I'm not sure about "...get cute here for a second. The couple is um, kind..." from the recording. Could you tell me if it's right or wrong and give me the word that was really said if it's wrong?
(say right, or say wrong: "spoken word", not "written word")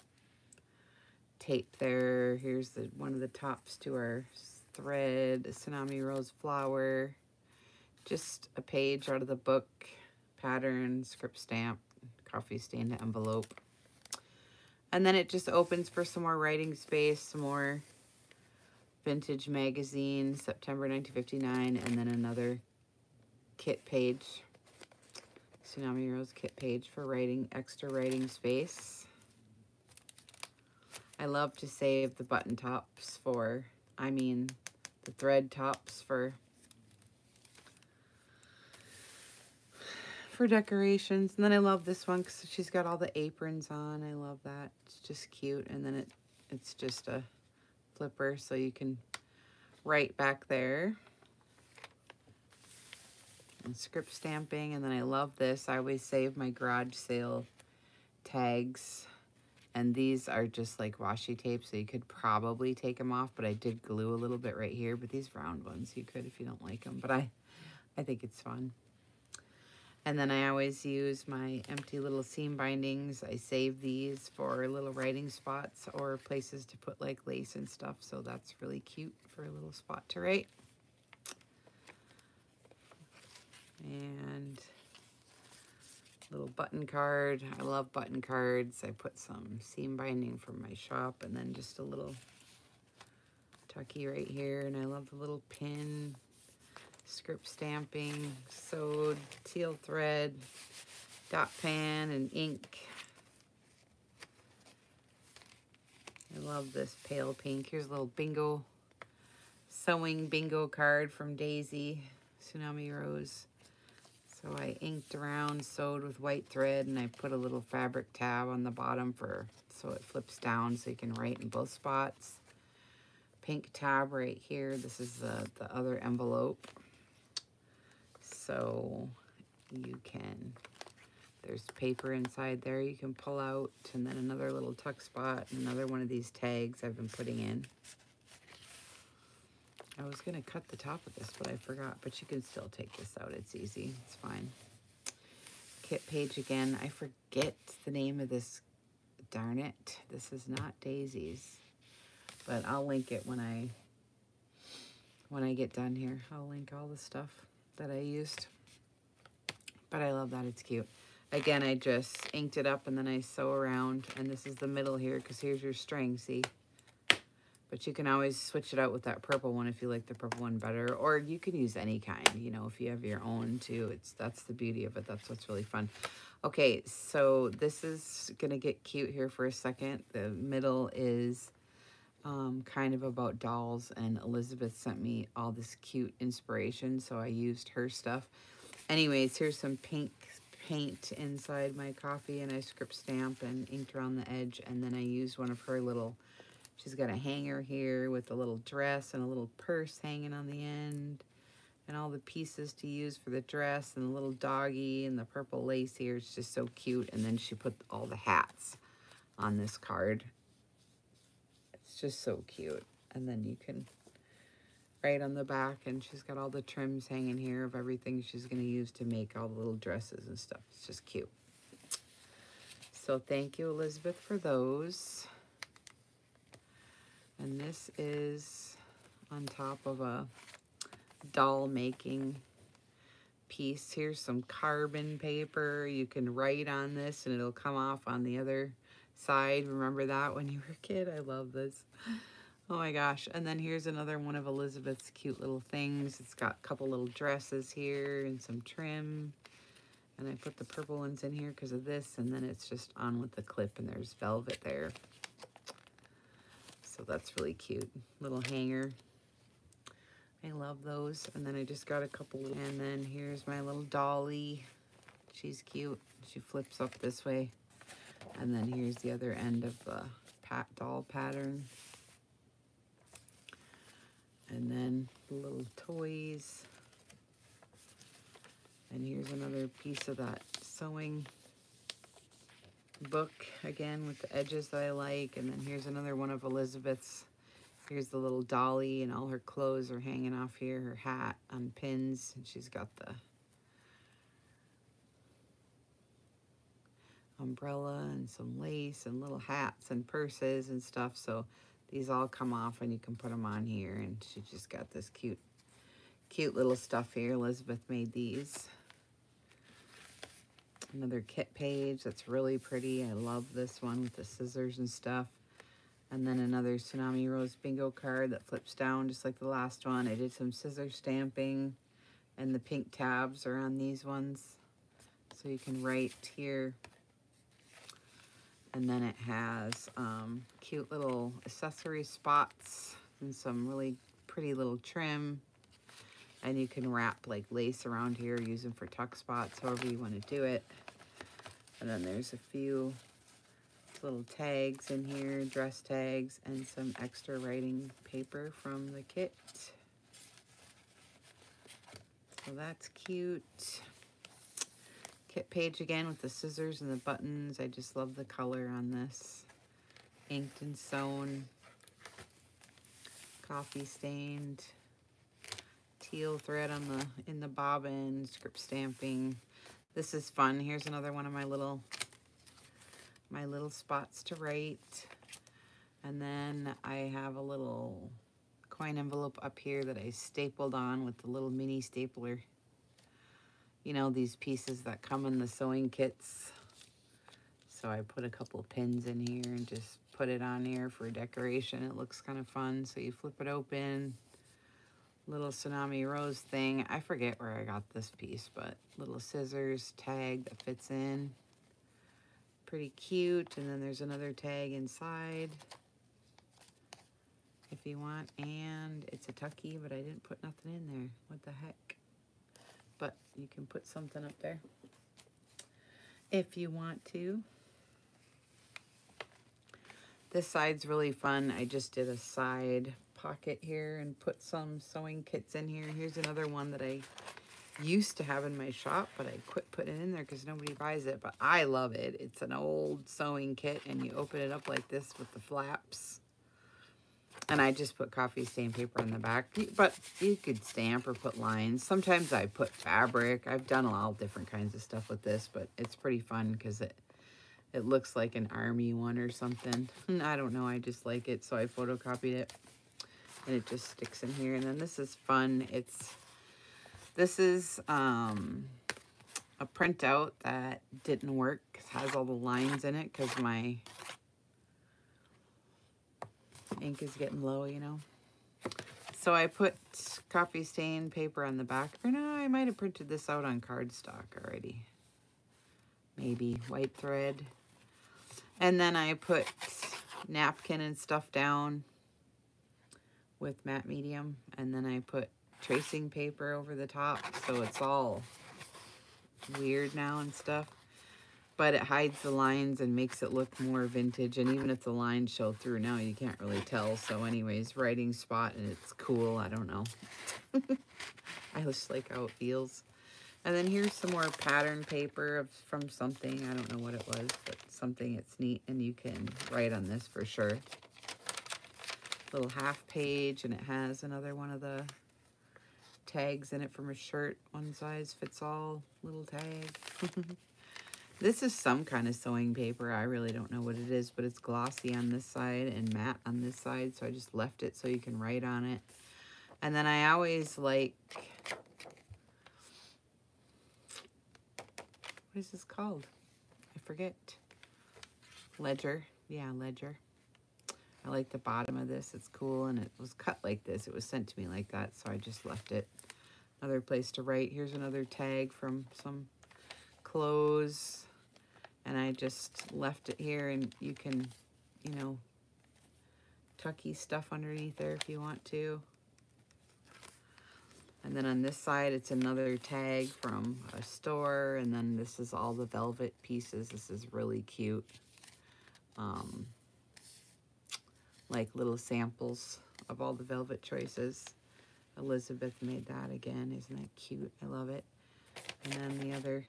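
wrong: "middle", not "couple".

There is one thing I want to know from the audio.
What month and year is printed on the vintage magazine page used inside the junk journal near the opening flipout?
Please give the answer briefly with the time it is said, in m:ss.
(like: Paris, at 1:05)
September 1959, at 0:20.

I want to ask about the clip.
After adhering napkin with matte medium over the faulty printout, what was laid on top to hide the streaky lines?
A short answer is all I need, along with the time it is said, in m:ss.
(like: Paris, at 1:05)
tracing paper, at 8:05.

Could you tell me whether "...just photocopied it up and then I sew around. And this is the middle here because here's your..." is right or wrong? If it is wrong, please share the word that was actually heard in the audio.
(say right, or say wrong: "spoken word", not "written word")
wrong: "inked", not "photocopied".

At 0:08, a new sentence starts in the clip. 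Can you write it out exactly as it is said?
Just a page out of the book pattern, script stamp, coffee stain envelope.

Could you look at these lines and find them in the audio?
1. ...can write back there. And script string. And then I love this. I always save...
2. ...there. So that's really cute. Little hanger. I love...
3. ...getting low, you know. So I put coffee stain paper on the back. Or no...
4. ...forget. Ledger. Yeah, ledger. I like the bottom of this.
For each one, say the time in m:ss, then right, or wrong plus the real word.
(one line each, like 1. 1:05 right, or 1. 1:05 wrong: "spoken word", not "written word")
1. 0:48 wrong: "stamping", not "string"
2. 4:14 right
3. 7:47 right
4. 8:56 right.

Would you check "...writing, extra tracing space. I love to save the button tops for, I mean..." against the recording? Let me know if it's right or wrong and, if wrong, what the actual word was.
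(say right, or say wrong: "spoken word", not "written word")
wrong: "writing", not "tracing".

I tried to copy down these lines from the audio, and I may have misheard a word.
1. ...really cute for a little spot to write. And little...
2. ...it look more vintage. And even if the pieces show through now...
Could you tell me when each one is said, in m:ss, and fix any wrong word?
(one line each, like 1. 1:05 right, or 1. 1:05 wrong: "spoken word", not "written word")
1. 1:18 right
2. 8:13 wrong: "lines", not "pieces".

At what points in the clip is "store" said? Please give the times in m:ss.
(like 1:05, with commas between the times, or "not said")
9:23.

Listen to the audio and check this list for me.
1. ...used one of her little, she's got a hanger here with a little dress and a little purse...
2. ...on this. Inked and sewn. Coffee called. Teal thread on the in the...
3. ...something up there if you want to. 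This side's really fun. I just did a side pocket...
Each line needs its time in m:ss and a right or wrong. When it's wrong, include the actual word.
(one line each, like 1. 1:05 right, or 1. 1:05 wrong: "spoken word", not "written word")
1. 3:15 right
2. 5:58 wrong: "stained", not "called"
3. 6:53 right.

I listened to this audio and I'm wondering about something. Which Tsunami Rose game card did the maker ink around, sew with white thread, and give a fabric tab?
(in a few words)
sewing bingo card.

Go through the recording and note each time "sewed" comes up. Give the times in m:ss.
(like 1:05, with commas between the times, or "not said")
1:38, 1:55.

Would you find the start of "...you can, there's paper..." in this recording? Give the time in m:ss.
2:09.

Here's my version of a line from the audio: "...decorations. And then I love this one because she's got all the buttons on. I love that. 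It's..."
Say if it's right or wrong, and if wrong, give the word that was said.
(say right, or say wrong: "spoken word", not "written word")
wrong: "aprons", not "buttons".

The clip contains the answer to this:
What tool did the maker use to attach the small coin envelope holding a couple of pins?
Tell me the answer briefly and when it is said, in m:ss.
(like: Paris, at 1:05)
mini stapler, at 6:21.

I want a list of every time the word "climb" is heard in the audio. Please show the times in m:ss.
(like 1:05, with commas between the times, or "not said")
not said.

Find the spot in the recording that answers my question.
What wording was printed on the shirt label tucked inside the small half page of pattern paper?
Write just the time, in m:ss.
8:37.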